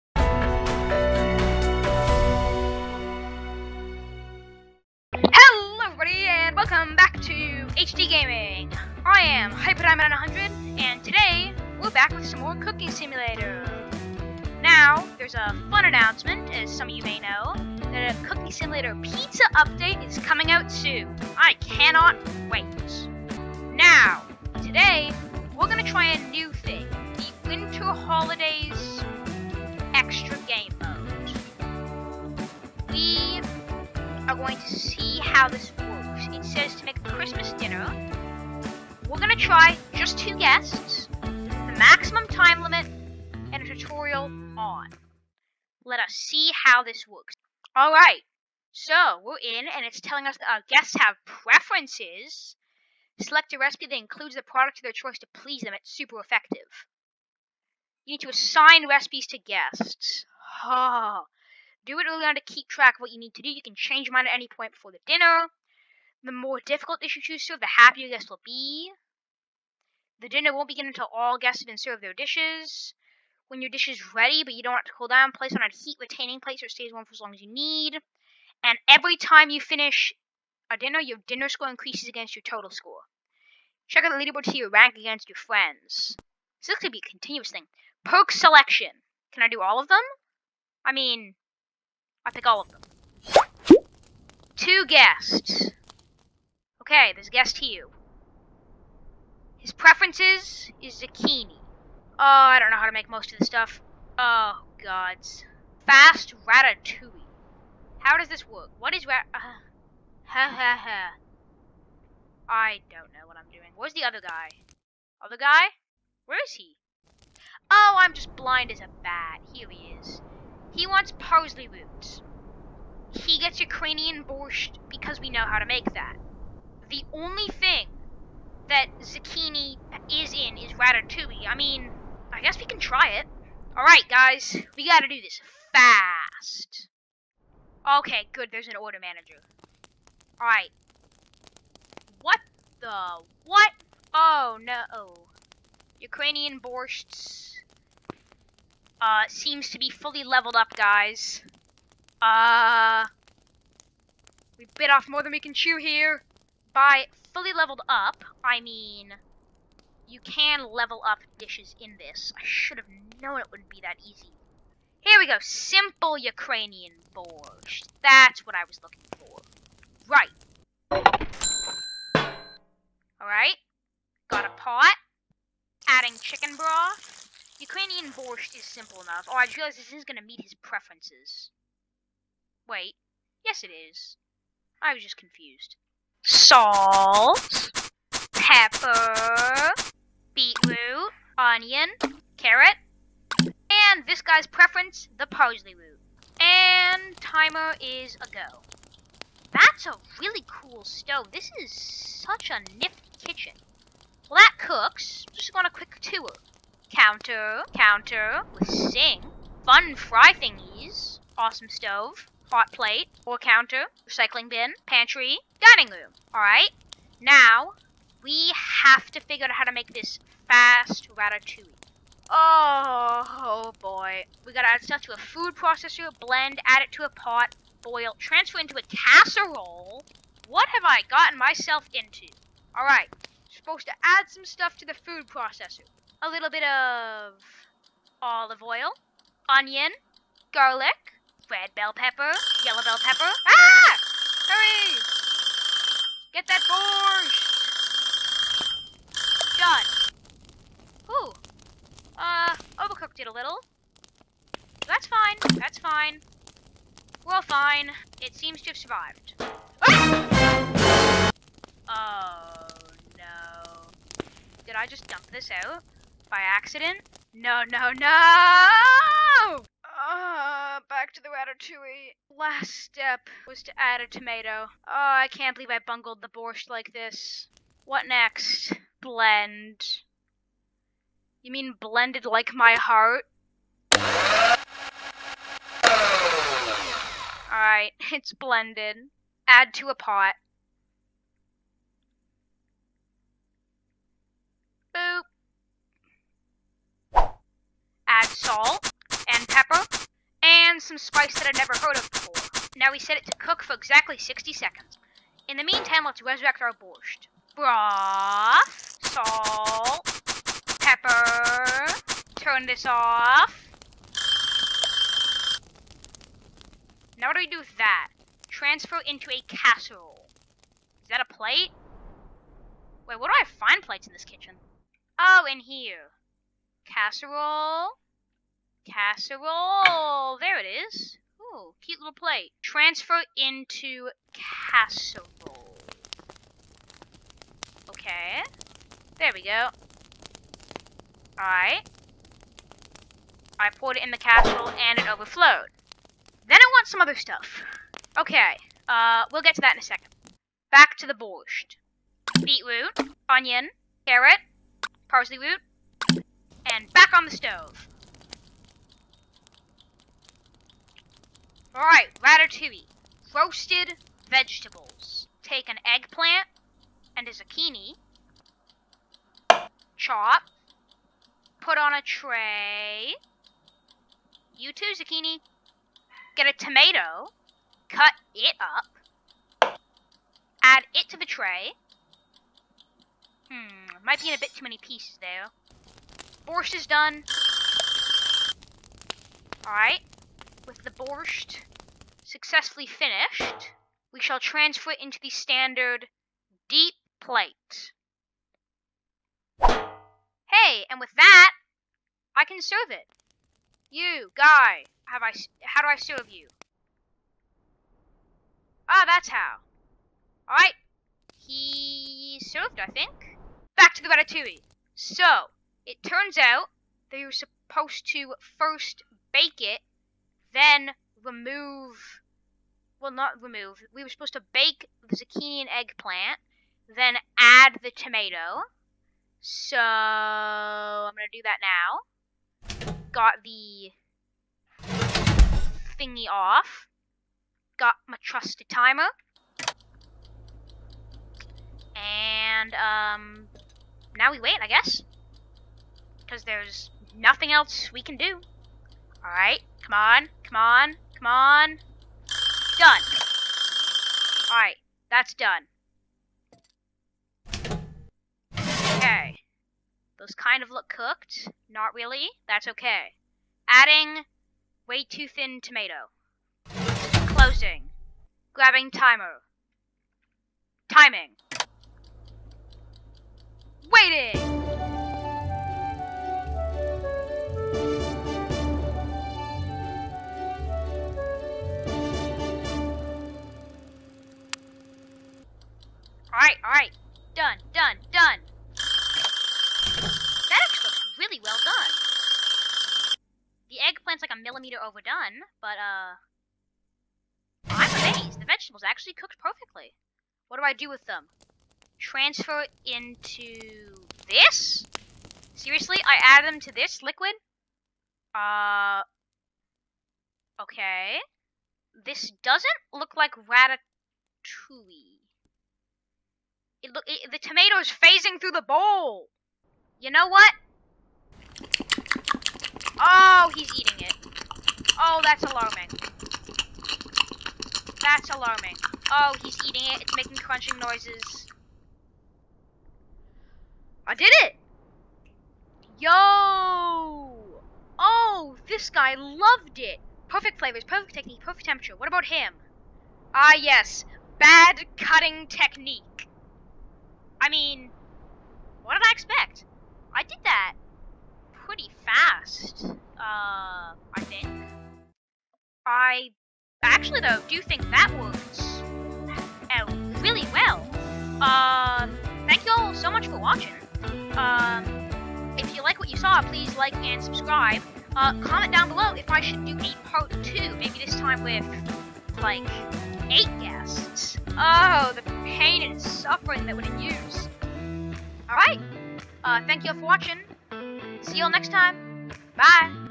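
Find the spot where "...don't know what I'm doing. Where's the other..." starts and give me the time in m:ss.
1:52.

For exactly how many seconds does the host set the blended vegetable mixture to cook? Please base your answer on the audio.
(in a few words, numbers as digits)
60.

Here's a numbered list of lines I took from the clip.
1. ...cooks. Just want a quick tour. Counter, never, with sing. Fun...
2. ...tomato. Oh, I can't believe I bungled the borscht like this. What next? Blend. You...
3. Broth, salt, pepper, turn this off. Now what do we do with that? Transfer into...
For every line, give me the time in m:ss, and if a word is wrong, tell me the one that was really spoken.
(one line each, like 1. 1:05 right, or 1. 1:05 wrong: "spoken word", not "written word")
1. 3:24 wrong: "counter", not "never"
2. 4:34 right
3. 5:07 right.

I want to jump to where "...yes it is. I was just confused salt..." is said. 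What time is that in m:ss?
3:03.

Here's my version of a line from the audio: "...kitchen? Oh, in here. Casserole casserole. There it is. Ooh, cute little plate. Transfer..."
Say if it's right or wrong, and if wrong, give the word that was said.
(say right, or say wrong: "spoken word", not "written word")
right.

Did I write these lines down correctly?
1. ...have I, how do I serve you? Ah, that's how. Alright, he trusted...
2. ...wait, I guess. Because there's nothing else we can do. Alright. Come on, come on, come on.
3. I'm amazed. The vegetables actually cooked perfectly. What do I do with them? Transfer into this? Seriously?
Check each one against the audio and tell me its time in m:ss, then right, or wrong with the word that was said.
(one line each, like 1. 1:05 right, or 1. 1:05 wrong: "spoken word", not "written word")
1. 6:45 wrong: "served", not "trusted"
2. 7:24 right
3. 8:17 right.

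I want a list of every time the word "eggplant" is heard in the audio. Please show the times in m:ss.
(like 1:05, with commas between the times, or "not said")
6:05, 7:05.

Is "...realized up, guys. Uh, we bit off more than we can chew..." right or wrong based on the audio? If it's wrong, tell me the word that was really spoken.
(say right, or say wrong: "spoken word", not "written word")
wrong: "leveled", not "realized".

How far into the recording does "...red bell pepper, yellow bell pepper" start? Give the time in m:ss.
4:01.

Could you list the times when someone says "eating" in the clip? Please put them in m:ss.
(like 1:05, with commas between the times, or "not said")
8:43, 8:49.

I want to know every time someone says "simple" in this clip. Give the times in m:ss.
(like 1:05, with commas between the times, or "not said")
2:45, 2:58.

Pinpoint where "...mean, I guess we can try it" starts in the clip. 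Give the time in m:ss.
2:11.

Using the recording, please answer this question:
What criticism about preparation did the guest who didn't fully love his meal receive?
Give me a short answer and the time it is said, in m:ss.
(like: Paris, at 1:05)
Bad cutting technique, at 9:04.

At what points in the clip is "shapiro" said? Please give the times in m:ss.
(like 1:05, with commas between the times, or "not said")
not said.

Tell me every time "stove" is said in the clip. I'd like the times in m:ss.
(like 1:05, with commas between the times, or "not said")
3:20, 3:31, 5:57.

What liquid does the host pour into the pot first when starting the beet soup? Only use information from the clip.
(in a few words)
Chicken broth.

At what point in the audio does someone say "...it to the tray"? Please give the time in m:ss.
6:20.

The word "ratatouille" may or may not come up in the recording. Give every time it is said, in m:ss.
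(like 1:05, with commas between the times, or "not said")
1:46, 2:10, 3:41, 4:31, 6:02, 6:54, 8:33.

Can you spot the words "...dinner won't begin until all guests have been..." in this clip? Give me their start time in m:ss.
1:10.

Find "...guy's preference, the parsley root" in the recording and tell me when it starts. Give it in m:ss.
3:14.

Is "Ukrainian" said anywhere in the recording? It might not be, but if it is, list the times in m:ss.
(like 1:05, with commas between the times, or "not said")
2:03, 2:26, 2:46, 2:57.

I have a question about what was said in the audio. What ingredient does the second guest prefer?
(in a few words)
Parsley roots.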